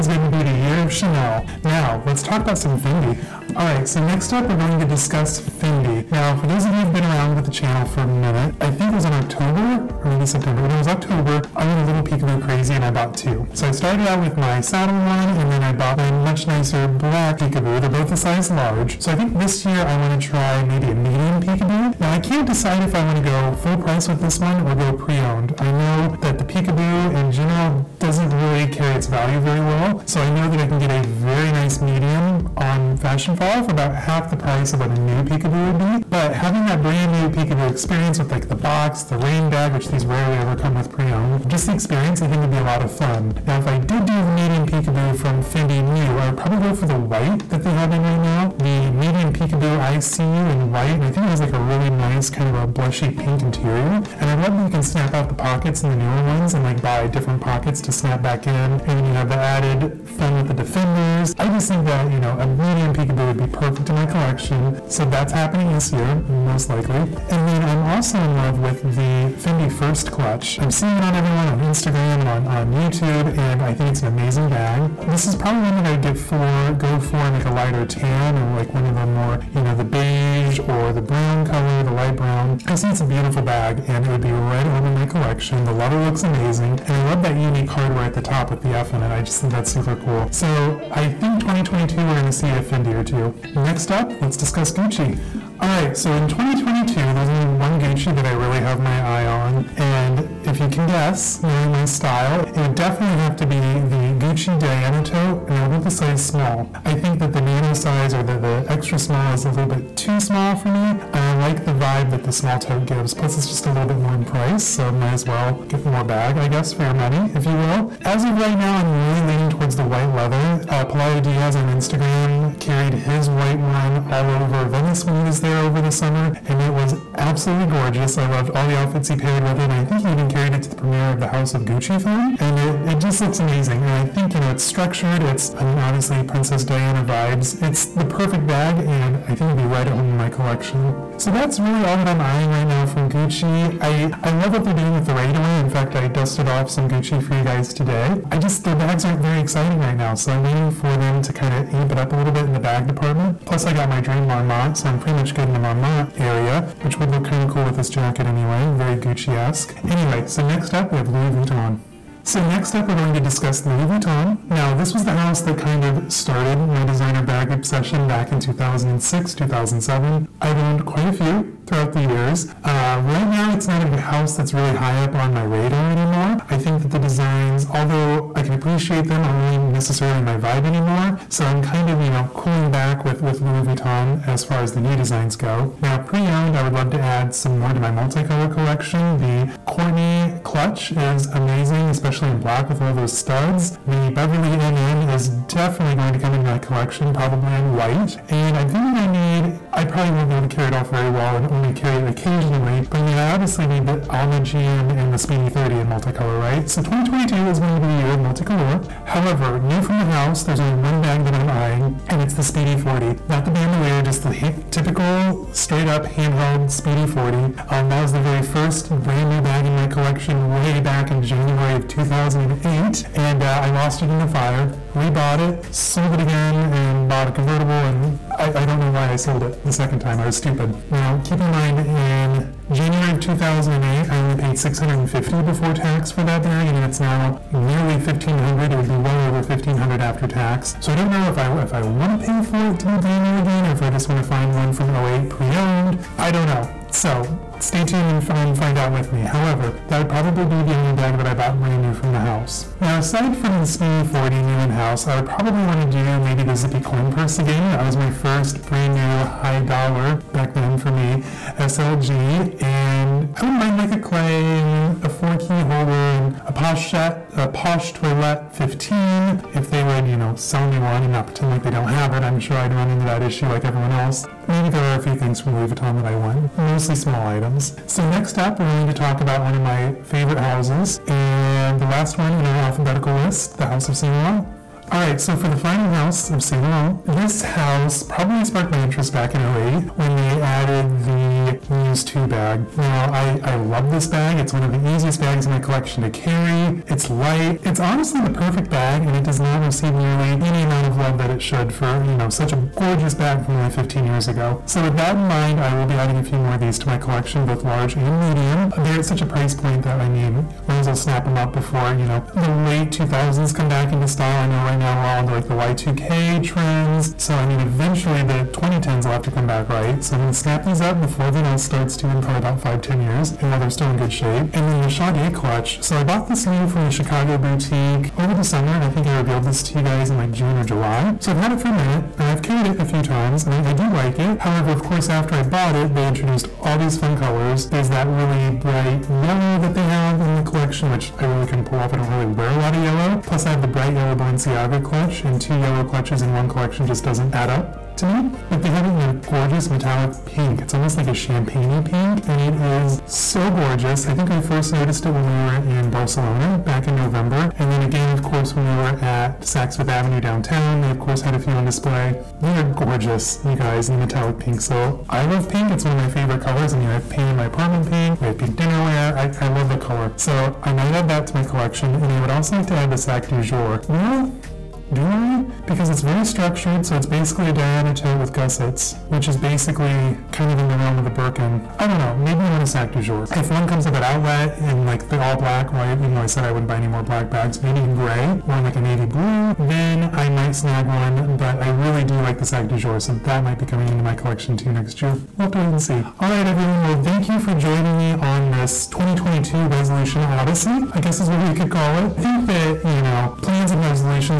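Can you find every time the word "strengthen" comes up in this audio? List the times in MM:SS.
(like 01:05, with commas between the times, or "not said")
not said.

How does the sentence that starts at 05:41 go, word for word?
I don't really wear a lot of yellow.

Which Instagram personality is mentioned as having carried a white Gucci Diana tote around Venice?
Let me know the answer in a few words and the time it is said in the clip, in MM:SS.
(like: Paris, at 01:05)
Pelayo Diaz, at 02:00.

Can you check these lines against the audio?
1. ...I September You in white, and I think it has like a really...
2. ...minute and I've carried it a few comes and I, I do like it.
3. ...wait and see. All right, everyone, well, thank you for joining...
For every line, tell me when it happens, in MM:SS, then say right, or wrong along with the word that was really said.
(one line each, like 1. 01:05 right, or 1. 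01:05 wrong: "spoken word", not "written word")
1. 00:49 wrong: "See", not "September"
2. 05:31 wrong: "times", not "comes"
3. 06:35 right.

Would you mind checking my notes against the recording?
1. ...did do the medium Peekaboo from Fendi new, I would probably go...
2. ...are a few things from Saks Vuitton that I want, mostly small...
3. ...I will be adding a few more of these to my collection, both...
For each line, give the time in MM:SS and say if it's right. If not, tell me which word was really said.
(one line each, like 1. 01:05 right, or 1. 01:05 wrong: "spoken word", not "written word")
1. 00:43 right
2. 04:34 wrong: "Louis", not "Saks"
3. 05:05 right.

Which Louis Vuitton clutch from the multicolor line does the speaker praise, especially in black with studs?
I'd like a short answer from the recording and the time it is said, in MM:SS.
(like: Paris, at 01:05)
Courtney clutch, at 03:09.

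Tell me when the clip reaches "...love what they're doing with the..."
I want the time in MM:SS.
02:24.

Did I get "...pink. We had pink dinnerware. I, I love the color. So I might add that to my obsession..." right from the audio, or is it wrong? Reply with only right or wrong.
wrong.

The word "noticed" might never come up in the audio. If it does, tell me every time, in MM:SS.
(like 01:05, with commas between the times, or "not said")
05:54.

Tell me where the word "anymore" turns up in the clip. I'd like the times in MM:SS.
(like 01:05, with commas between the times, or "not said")
02:55, 03:00.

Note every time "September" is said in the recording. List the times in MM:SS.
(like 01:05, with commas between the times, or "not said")
00:10.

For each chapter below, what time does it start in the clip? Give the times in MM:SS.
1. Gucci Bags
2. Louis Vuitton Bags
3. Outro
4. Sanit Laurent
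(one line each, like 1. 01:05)
1. 01:35
2. 02:41
3. 06:36
4. 04:44.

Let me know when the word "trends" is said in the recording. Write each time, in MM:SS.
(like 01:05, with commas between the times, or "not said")
05:16.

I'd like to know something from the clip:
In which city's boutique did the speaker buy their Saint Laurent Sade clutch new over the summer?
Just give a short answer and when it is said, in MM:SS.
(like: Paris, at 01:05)
Chicago, at 05:26.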